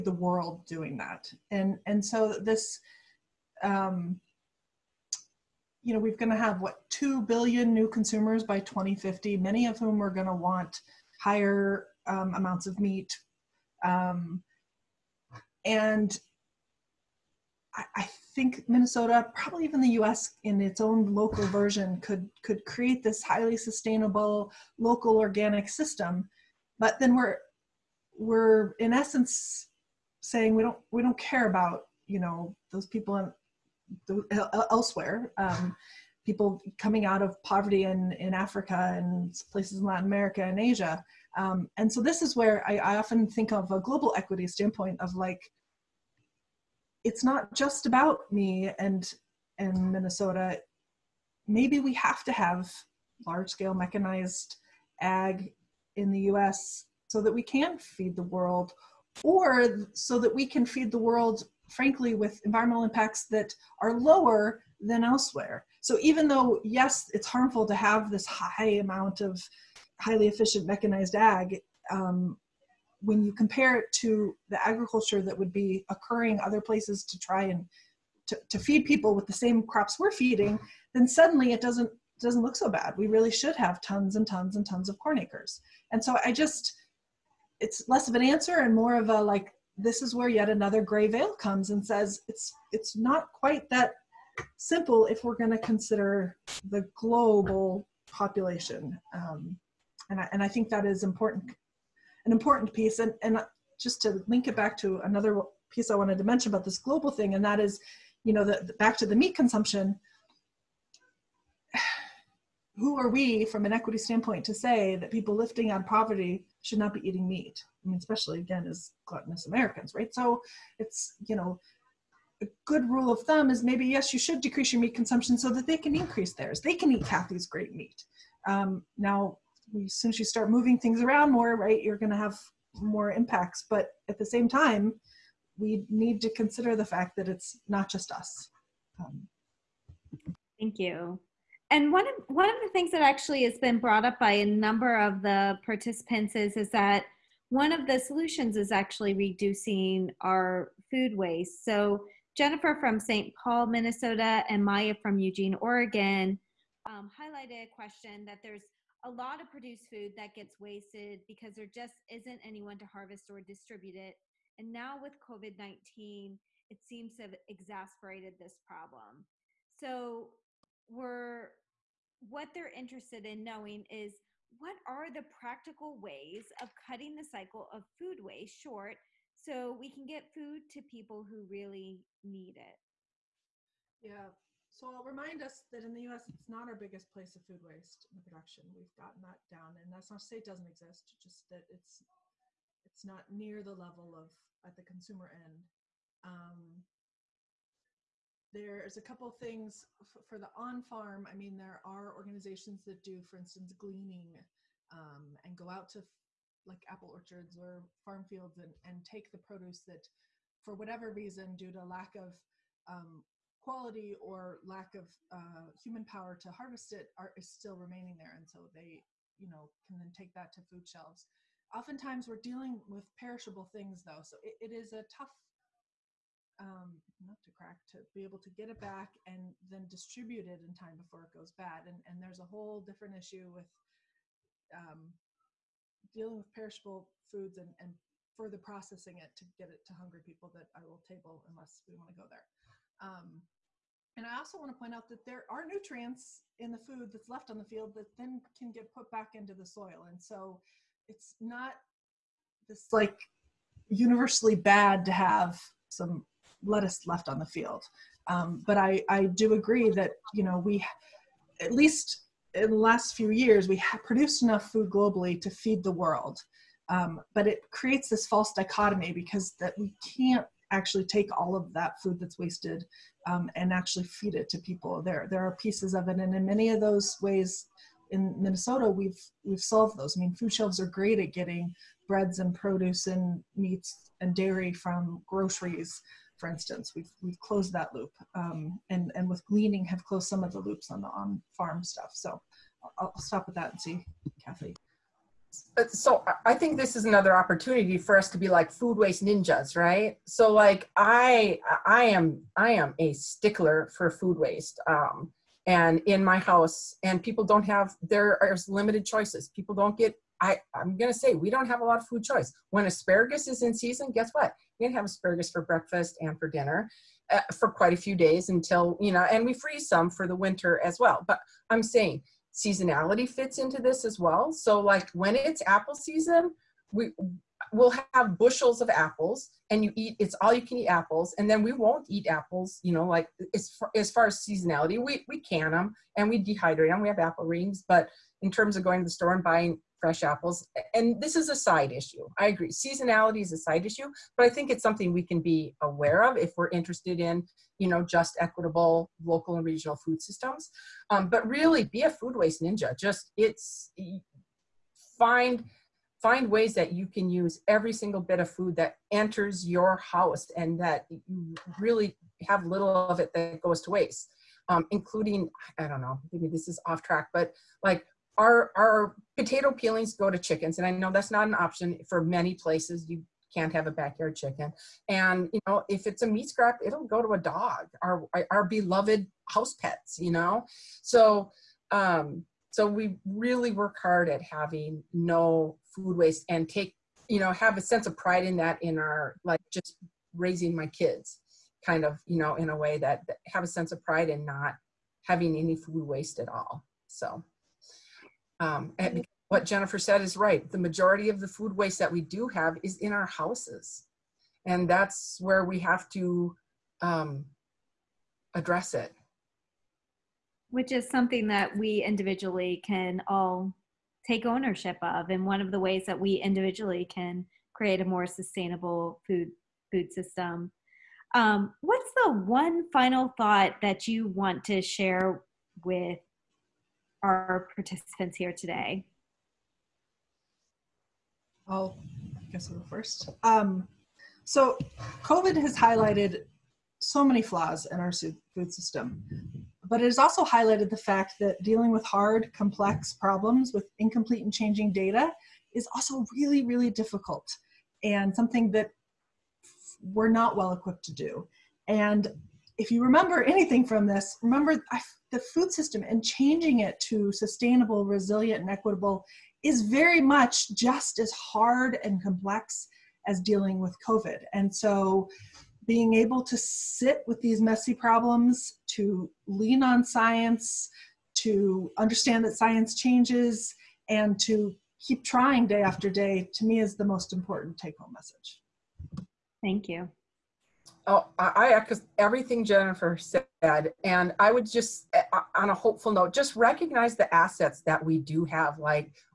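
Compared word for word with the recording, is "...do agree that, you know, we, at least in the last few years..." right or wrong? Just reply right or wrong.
right.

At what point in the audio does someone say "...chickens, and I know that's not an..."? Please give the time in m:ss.
6:10.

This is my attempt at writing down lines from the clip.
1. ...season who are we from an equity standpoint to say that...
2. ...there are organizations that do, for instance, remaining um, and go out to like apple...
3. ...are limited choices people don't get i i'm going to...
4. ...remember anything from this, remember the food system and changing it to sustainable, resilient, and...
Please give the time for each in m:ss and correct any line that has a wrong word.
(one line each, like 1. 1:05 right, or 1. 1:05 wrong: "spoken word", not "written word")
1. 1:49 wrong: "consumption", not "season"
2. 3:21 wrong: "gleaning", not "remaining"
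3. 5:08 right
4. 7:33 right.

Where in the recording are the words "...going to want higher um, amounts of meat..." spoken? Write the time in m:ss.
0:10.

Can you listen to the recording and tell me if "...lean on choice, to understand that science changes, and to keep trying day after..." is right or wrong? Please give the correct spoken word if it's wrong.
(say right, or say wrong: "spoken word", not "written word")
wrong: "science", not "choice".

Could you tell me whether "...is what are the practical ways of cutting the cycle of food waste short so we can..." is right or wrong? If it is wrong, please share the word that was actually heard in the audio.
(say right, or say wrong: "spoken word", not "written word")
right.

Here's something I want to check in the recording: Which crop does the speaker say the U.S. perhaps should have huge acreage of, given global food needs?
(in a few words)
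Corn.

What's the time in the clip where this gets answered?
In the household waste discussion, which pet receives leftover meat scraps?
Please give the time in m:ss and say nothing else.
6:17.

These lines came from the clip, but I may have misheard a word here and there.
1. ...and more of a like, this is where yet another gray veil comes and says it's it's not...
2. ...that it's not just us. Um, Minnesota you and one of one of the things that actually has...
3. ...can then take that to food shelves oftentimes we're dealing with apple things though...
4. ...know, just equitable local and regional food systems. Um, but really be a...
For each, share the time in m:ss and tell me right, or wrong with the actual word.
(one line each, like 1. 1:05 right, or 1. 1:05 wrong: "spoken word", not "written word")
1. 1:28 right
2. 2:17 wrong: "Thank", not "Minnesota"
3. 3:39 wrong: "perishable", not "apple"
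4. 5:47 right.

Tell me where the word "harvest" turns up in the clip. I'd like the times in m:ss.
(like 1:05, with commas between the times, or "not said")
2:42, 3:36.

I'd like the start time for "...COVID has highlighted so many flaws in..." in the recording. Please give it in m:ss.
7:15.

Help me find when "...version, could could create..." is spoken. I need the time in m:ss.
0:21.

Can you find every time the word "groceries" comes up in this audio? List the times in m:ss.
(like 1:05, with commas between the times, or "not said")
4:45.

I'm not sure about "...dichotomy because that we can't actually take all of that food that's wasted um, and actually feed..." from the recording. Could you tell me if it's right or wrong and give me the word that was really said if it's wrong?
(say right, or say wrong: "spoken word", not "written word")
right.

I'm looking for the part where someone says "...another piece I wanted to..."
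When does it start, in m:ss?
1:44.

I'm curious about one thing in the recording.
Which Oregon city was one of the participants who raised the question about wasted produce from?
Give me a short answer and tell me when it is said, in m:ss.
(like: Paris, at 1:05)
Eugene, at 2:35.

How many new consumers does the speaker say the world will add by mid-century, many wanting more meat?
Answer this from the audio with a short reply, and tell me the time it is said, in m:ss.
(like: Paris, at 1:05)
2 billion, at 0:06.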